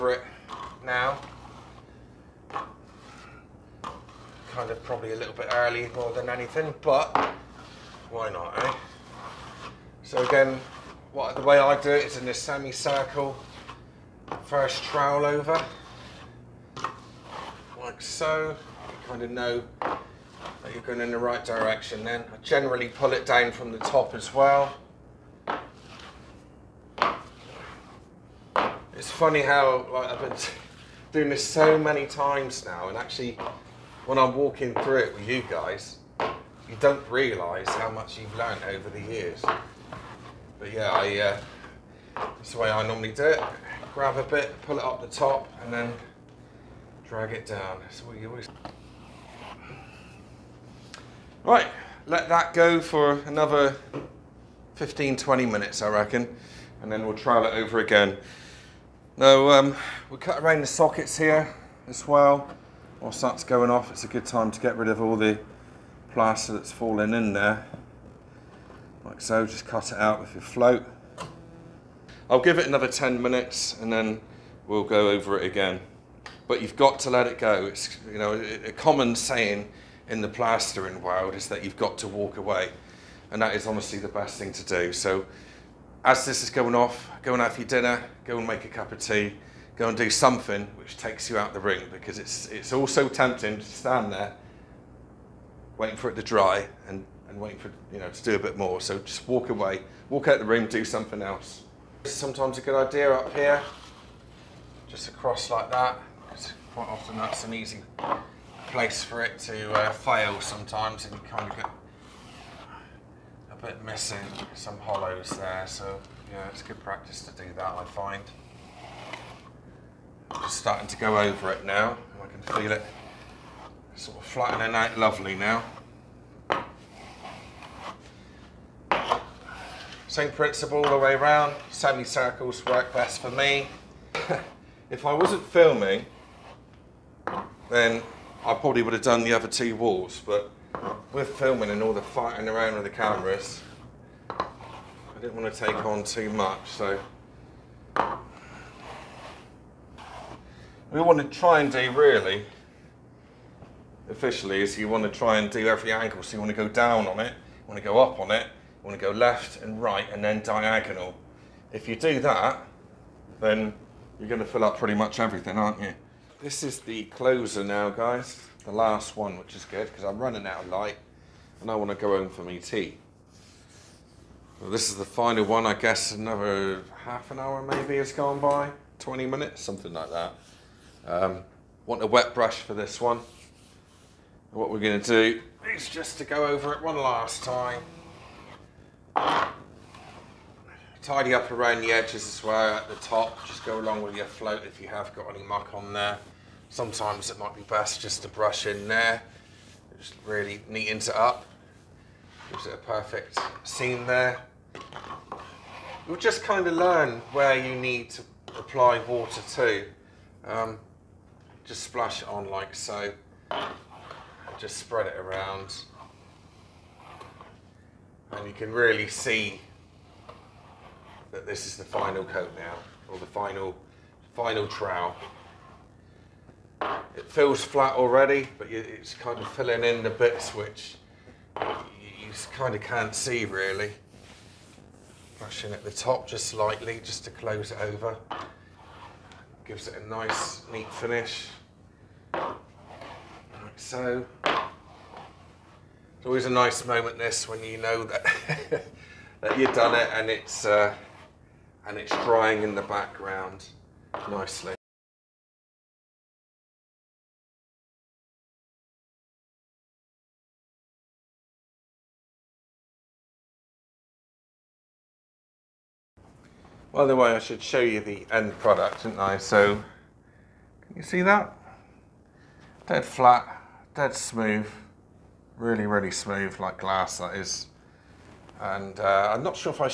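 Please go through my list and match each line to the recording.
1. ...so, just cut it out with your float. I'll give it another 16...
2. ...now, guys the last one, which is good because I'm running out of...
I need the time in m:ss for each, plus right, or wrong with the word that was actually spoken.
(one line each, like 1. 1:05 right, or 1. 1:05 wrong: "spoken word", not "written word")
1. 1:09 wrong: "10", not "16"
2. 2:47 right.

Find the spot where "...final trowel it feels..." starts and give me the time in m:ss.
3:44.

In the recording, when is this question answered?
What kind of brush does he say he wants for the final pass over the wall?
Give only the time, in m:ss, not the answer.
3:02.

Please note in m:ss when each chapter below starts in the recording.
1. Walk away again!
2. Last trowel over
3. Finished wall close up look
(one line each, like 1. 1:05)
1. 1:12
2. 3:07
3. 4:26.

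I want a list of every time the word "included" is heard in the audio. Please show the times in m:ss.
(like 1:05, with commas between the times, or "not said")
not said.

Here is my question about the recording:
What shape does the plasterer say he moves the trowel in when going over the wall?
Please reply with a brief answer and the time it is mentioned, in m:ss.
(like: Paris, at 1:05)
Semicircle, at 0:12.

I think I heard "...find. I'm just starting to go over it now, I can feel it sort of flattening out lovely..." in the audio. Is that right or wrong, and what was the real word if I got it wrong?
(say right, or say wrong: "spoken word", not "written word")
right.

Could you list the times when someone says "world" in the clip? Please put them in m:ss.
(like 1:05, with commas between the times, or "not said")
1:21.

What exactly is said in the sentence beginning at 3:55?
Brushing at the top just slightly, just to close it over.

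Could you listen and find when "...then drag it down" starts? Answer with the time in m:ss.
0:45.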